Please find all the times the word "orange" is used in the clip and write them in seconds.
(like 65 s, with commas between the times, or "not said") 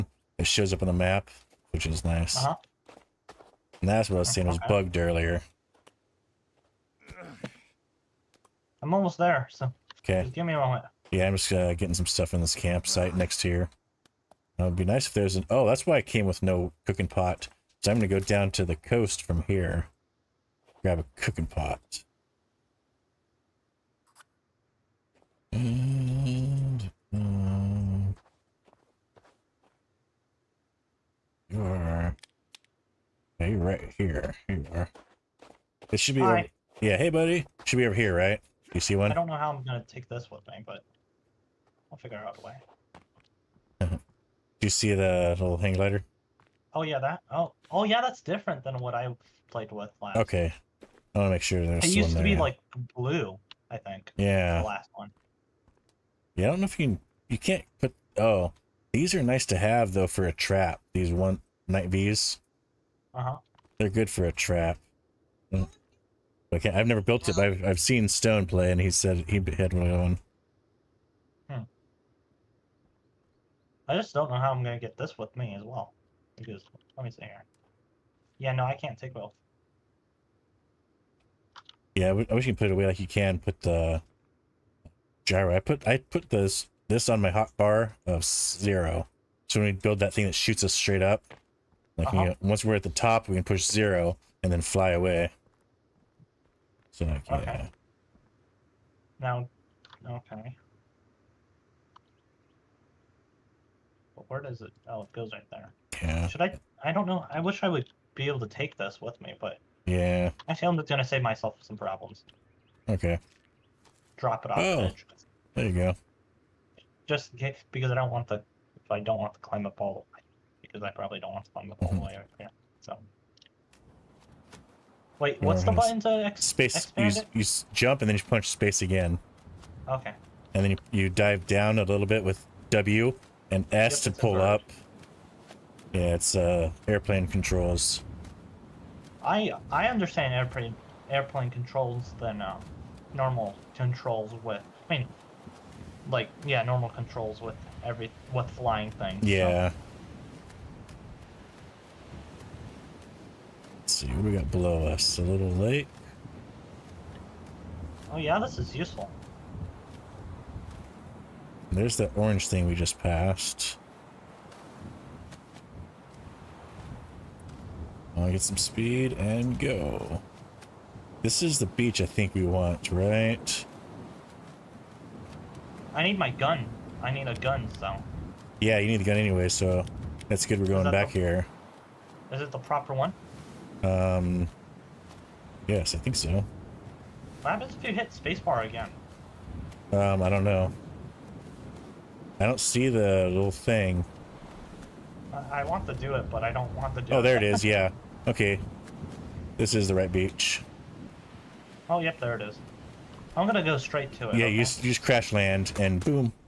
162 s.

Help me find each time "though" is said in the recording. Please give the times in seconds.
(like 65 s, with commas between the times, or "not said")
59 s.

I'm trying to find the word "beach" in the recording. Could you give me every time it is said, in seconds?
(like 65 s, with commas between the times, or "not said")
171 s, 200 s.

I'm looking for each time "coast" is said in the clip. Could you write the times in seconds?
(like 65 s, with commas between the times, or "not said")
18 s.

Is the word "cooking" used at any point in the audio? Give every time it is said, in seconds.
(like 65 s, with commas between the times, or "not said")
16 s, 21 s.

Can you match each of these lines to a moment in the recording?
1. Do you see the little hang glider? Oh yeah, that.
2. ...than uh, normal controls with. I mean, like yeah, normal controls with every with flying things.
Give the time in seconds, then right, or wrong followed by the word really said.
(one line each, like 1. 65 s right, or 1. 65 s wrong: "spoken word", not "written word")
1. 43 s right
2. 142 s right.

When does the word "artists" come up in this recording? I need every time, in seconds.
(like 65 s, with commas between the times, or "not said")
not said.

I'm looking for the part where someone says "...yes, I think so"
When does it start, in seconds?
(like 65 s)
185 s.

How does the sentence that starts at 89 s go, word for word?
So when we build that thing that shoots us straight up, uh -huh.